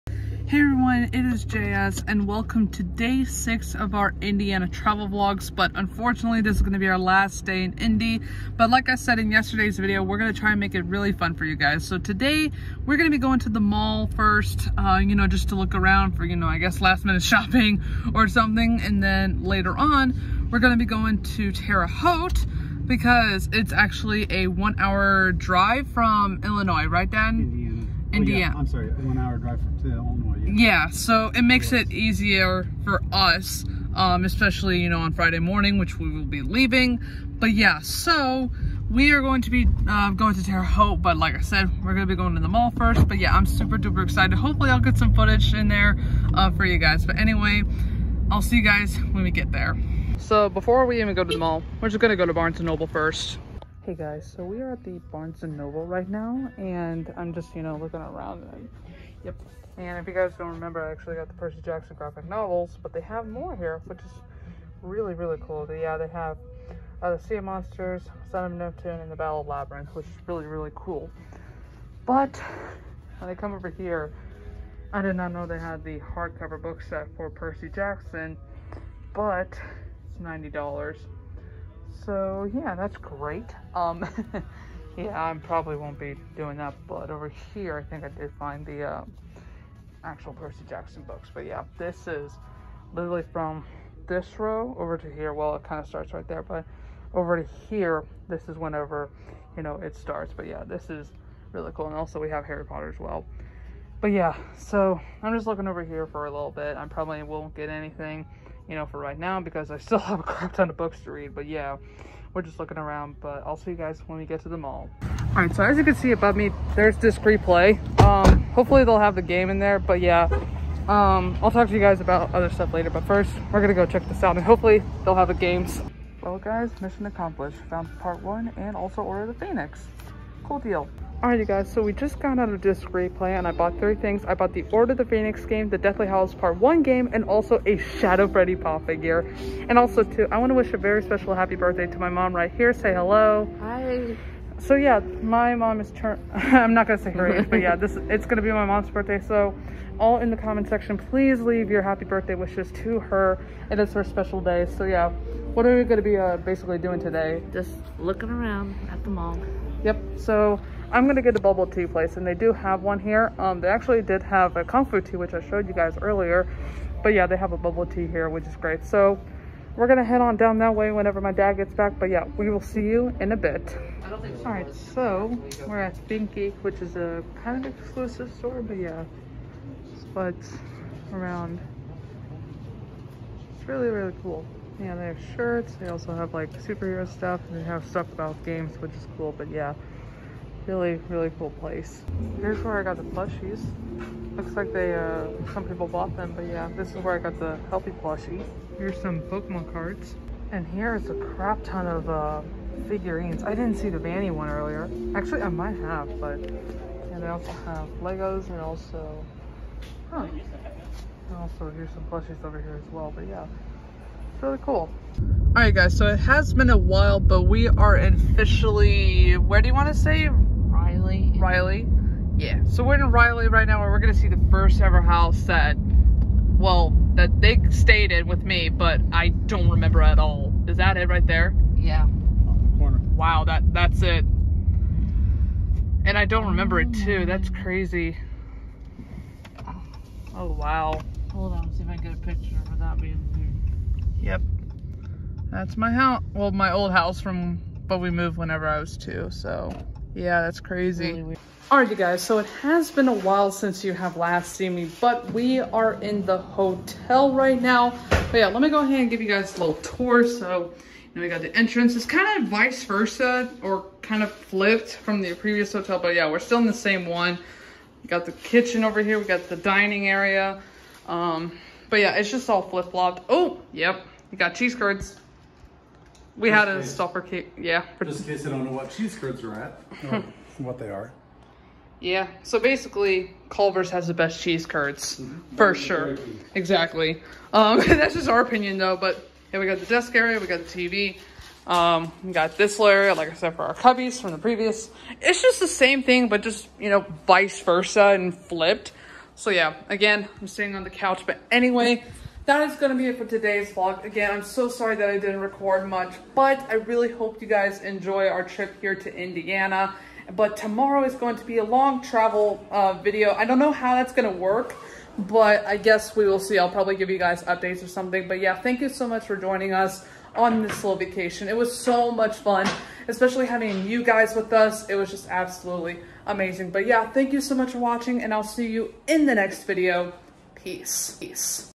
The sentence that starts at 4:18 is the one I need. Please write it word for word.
But yeah, let me go ahead and give you guys a little tour.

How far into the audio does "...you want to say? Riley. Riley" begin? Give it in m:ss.
3:39.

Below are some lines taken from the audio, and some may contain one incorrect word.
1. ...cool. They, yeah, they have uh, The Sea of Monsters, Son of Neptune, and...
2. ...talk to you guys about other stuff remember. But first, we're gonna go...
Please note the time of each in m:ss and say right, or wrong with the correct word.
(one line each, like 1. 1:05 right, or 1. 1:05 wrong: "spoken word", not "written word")
1. 1:05 right
2. 2:01 wrong: "later", not "remember".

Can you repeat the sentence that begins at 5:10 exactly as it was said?
But tomorrow is going to be a long travel uh, video.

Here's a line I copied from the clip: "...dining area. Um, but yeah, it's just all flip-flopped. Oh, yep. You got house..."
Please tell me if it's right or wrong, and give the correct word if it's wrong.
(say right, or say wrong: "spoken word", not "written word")
wrong: "cheese", not "house".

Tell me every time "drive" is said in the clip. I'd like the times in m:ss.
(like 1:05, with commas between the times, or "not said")
0:25, 0:29.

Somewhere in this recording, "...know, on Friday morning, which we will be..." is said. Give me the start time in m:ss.
0:34.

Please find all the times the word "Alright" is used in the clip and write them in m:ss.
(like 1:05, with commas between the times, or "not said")
2:11, 4:11.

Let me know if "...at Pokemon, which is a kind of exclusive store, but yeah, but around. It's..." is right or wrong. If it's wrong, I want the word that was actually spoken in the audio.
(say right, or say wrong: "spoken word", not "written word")
wrong: "Binky", not "Pokemon".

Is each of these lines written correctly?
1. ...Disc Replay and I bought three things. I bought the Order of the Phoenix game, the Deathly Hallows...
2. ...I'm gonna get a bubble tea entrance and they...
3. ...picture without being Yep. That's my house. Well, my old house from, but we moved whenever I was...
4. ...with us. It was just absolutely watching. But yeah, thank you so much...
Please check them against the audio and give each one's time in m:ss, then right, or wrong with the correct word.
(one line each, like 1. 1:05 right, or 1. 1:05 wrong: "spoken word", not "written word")
1. 2:12 right
2. 2:40 wrong: "place", not "entrance"
3. 4:02 right
4. 5:24 wrong: "amazing", not "watching".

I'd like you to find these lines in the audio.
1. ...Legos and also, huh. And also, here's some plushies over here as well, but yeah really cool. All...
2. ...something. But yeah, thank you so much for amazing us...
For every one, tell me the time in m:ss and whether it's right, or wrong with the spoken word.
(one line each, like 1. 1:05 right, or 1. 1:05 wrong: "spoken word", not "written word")
1. 3:28 right
2. 5:17 wrong: "joining", not "amazing".